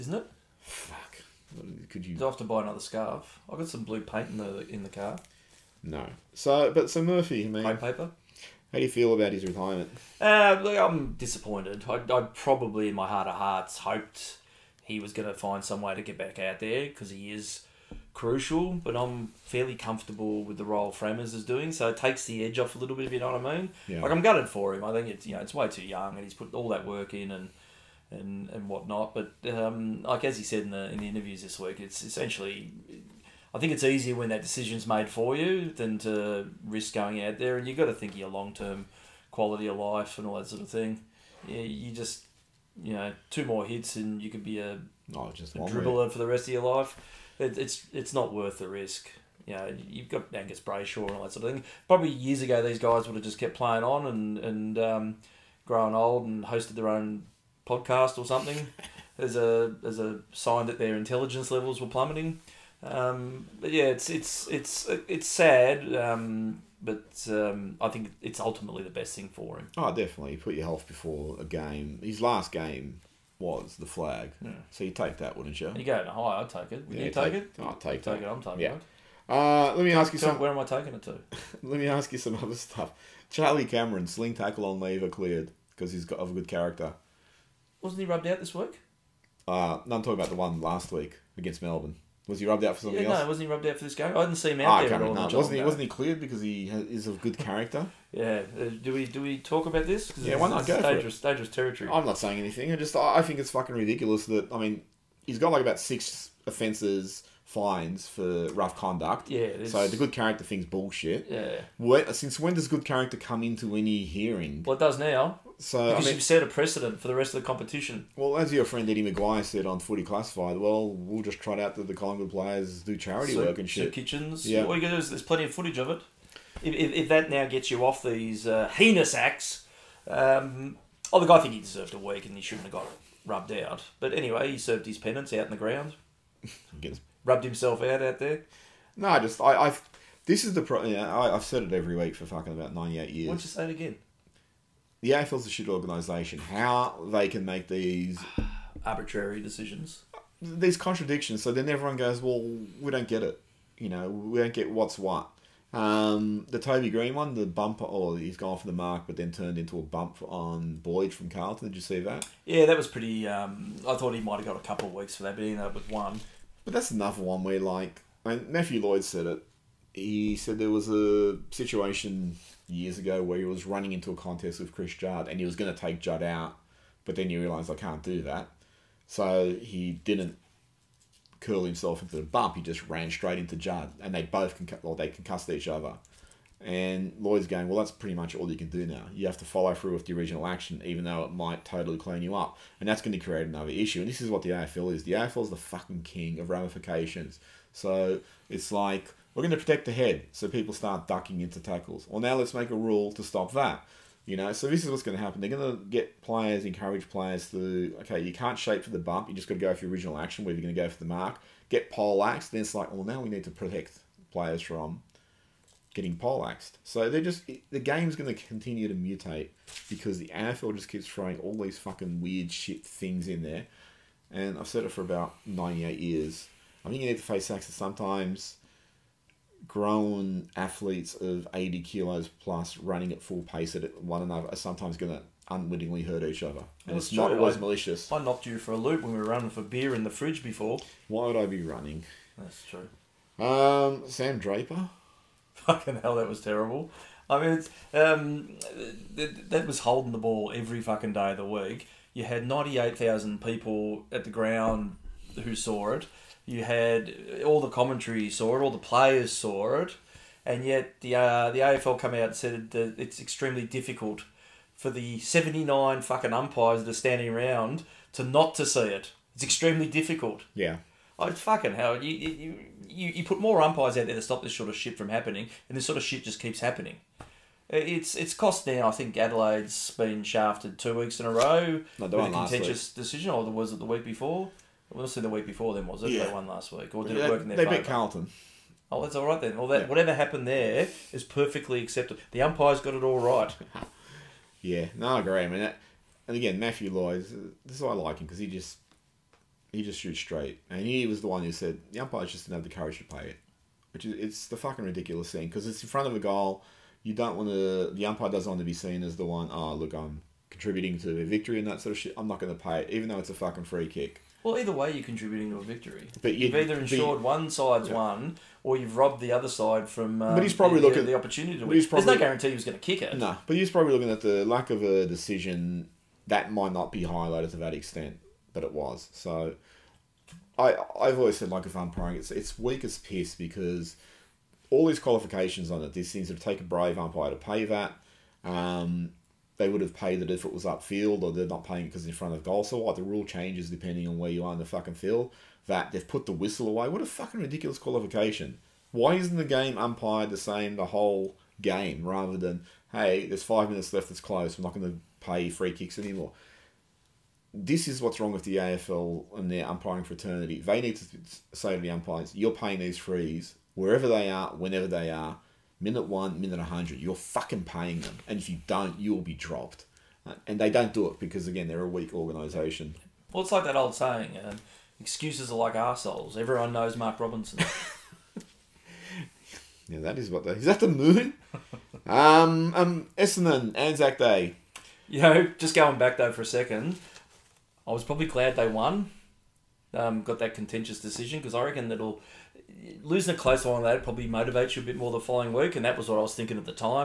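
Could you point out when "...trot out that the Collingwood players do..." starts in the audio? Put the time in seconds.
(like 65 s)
121 s.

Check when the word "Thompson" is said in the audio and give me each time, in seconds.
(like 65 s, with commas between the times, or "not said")
not said.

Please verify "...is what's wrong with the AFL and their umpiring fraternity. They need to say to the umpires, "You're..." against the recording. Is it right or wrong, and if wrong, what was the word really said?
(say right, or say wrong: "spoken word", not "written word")
right.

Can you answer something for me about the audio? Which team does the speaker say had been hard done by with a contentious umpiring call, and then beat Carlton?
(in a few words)
Adelaide.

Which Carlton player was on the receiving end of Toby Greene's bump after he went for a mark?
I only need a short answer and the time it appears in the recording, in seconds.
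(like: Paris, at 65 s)
Boyd, at 160 s.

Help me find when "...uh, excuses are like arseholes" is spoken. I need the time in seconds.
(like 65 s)
374 s.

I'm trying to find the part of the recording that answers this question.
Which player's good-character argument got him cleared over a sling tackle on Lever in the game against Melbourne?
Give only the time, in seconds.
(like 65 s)
83 s.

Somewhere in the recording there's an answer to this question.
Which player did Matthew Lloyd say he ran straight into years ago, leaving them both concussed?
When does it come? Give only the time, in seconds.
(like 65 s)
174 s.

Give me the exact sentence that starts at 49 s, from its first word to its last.
You know, you've got Angus Brayshaw and all that sort of thing.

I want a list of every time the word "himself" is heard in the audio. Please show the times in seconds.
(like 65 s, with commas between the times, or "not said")
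137 s, 181 s.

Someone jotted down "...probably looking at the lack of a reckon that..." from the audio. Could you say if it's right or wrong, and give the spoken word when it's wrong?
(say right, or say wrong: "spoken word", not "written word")
wrong: "decision", not "reckon".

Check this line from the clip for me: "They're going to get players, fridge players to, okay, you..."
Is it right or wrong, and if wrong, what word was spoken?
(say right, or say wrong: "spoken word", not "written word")
wrong: "encourage", not "fridge".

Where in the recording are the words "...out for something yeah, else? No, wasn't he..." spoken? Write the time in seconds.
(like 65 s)
92 s.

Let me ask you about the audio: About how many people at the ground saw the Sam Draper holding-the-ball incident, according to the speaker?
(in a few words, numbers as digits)
98,000.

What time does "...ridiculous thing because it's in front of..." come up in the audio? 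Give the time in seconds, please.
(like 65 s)
304 s.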